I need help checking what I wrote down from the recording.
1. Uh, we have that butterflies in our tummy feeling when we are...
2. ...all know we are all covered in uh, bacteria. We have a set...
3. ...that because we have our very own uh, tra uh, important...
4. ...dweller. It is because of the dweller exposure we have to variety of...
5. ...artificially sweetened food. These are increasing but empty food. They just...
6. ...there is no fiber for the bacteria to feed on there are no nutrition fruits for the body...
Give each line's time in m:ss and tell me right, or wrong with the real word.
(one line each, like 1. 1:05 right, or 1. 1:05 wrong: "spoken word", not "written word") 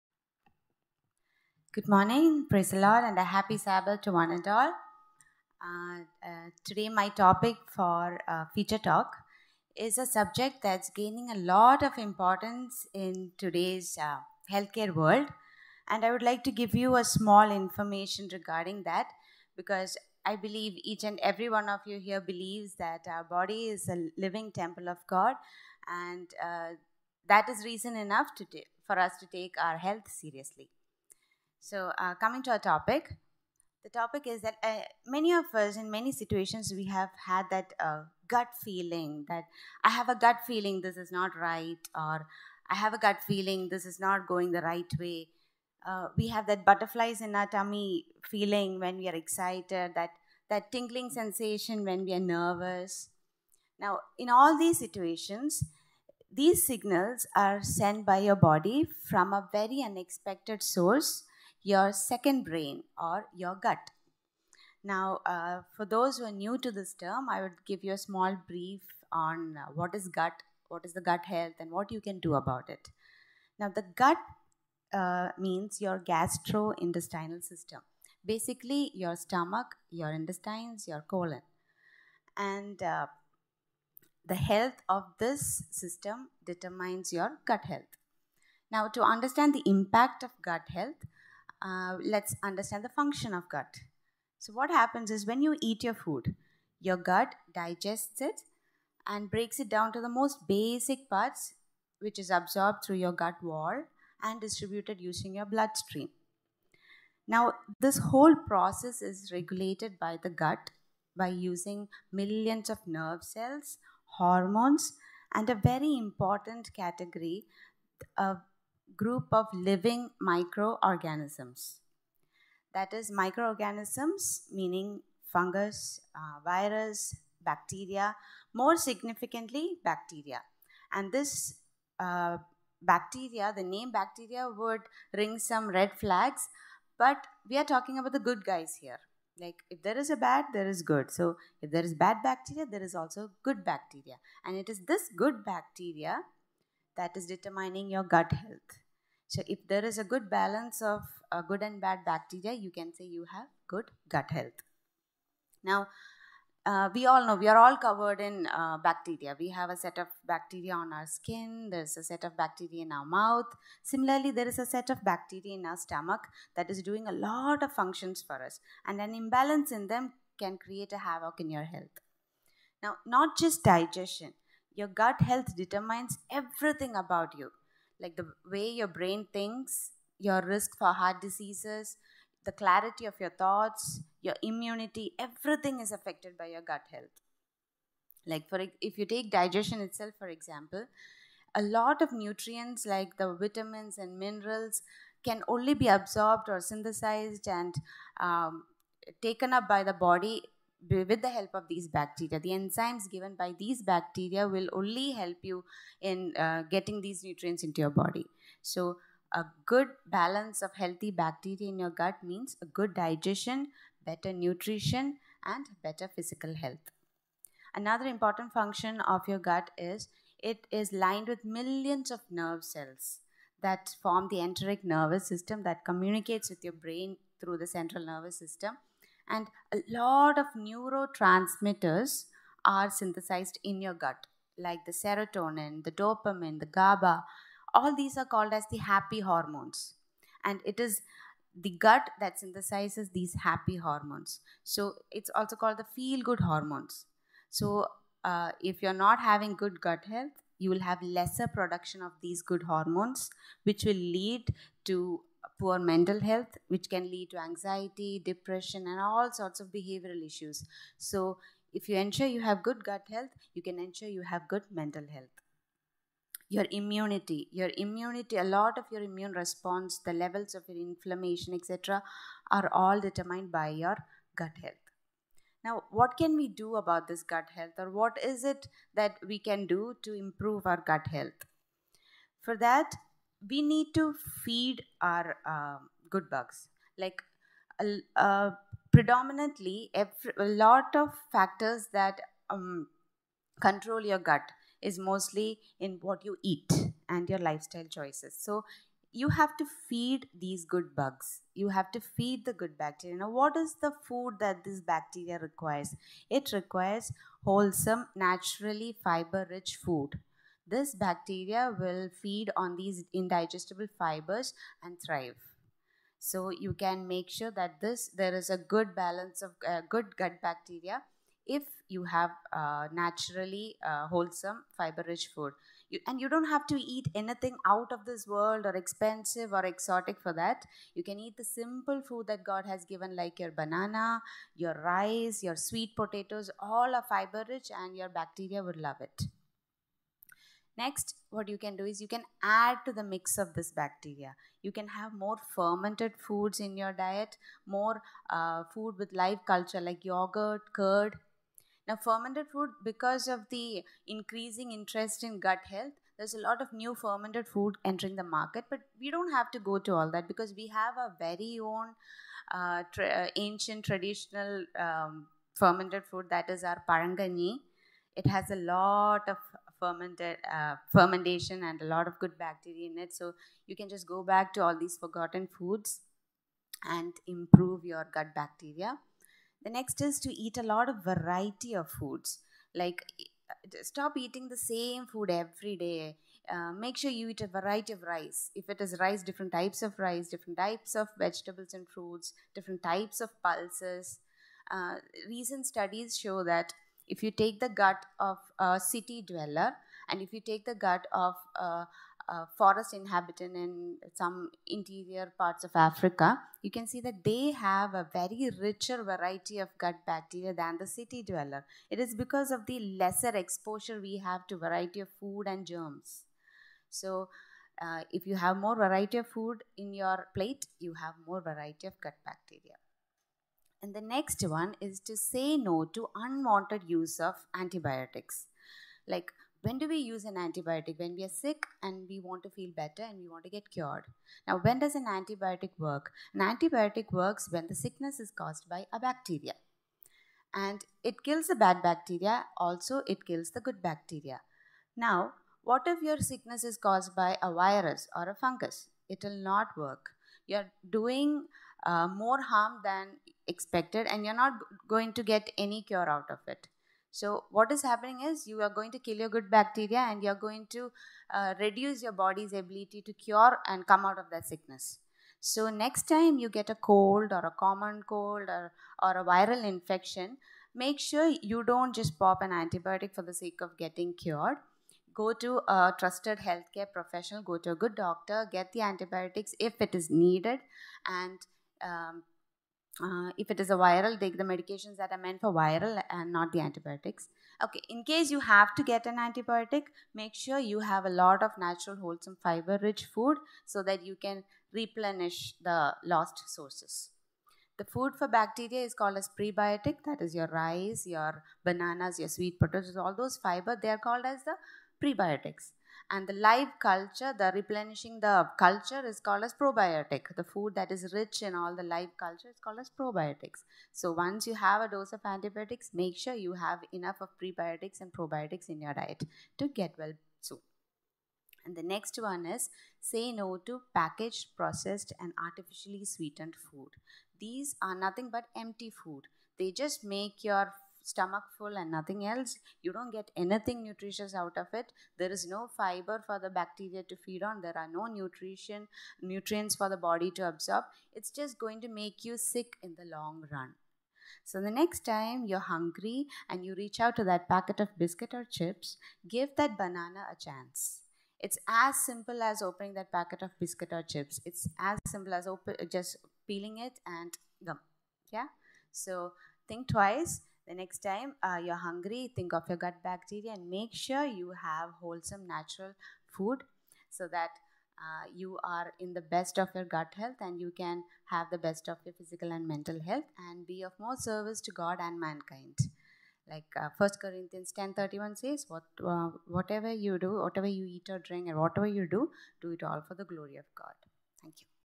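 1. 0:45 right
2. 2:37 right
3. 6:00 wrong: "ancient", not "important"
4. 6:51 wrong: "lesser", not "dweller"
5. 8:45 wrong: "nothing", not "increasing"
6. 8:55 wrong: "nutrients", not "fruits".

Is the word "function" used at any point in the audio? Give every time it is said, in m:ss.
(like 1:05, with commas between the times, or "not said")
1:32, 2:47, 3:38.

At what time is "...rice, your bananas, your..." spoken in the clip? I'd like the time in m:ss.
8:20.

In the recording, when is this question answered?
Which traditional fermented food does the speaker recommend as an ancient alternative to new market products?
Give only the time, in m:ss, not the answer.
6:06.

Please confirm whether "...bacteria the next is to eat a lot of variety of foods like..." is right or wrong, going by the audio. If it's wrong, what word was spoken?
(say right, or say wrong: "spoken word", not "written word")
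right.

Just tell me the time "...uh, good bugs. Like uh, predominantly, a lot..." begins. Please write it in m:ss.
4:45.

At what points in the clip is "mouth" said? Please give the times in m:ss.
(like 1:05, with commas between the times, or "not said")
2:43.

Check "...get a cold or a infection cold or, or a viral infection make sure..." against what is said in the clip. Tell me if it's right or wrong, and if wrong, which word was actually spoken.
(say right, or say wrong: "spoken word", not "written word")
wrong: "common", not "infection".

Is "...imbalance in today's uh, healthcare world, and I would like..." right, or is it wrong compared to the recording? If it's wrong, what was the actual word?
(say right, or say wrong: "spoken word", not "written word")
wrong: "importance", not "imbalance".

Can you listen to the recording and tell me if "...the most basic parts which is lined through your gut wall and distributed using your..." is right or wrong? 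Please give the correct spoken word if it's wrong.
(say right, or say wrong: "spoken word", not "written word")
wrong: "absorbed", not "lined".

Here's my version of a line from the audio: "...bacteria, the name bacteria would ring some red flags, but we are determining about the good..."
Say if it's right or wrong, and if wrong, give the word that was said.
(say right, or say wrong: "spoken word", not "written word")
wrong: "talking", not "determining".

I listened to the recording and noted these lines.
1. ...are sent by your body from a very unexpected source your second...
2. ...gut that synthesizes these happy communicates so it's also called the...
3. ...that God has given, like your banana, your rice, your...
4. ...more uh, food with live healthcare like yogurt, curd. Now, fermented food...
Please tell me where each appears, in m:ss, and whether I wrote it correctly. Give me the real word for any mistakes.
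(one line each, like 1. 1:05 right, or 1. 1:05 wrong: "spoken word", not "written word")
1. 0:57 right
2. 4:01 wrong: "hormones", not "communicates"
3. 5:32 right
4. 5:47 wrong: "culture", not "healthcare".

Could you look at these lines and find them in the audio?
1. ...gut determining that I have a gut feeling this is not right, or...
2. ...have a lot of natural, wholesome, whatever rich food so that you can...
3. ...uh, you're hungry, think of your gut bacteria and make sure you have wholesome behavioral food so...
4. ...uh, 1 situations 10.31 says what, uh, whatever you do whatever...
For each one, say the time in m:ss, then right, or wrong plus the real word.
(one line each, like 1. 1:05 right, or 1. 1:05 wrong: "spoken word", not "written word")
1. 0:38 wrong: "feeling", not "determining"
2. 8:10 wrong: "fiber", not "whatever"
3. 9:21 wrong: "natural", not "behavioral"
4. 9:36 wrong: "corinthians", not "situations".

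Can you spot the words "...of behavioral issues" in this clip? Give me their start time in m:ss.
4:19.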